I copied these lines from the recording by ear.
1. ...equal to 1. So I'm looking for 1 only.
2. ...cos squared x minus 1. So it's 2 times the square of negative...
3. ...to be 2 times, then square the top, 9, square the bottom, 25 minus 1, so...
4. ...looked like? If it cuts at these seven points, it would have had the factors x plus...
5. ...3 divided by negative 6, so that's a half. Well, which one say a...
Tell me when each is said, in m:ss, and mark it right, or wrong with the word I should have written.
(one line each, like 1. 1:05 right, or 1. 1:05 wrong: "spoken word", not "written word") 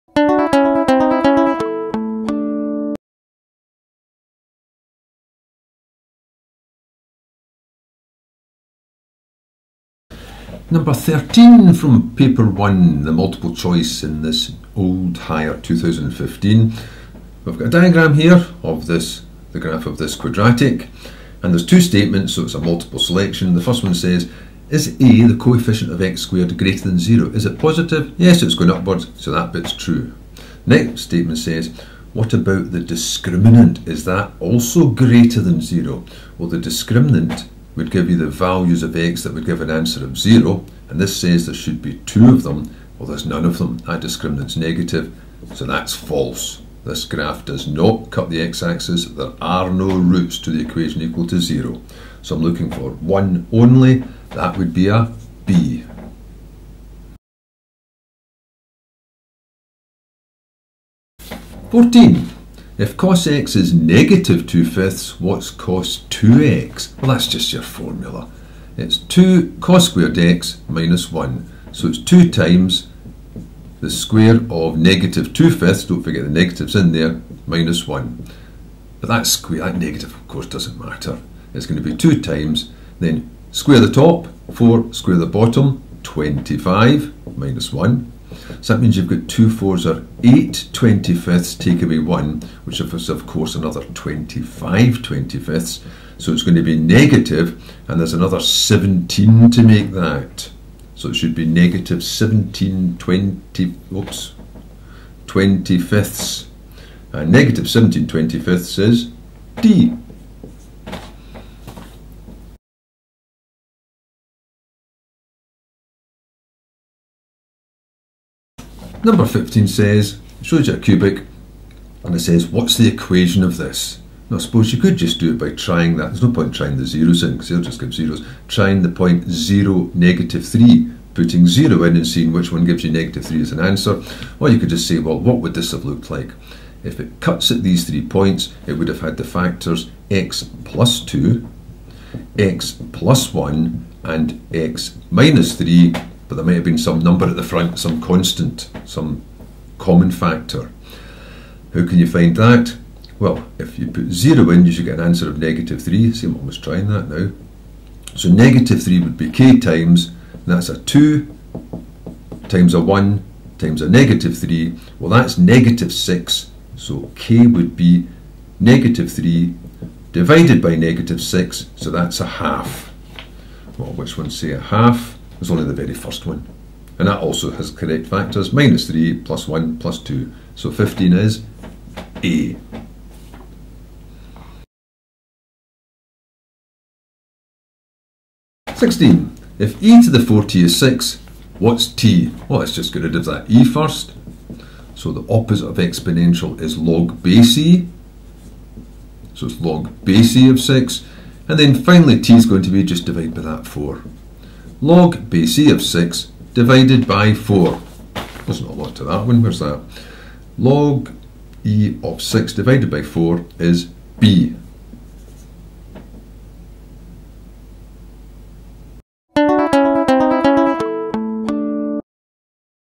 1. 0:51 wrong: "0", not "1"
2. 1:09 right
3. 1:21 wrong: "4", not "9"
4. 2:15 wrong: "three", not "seven"
5. 2:49 right.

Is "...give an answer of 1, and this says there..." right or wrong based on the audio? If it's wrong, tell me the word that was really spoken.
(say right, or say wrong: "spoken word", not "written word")
wrong: "0", not "1".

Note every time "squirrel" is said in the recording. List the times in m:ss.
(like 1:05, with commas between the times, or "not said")
not said.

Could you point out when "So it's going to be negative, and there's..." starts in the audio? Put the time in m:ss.
1:36.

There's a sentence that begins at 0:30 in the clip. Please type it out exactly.
Next statement says, what about the discriminant?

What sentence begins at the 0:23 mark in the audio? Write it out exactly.
The first one says, is A, the coefficient of x squared, greater than zero?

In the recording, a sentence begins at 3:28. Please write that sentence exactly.
There's not a lot to that one, where's that?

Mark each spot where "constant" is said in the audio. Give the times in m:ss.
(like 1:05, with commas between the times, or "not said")
2:27.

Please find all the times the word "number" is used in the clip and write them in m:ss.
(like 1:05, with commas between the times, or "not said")
0:10, 1:59, 2:26.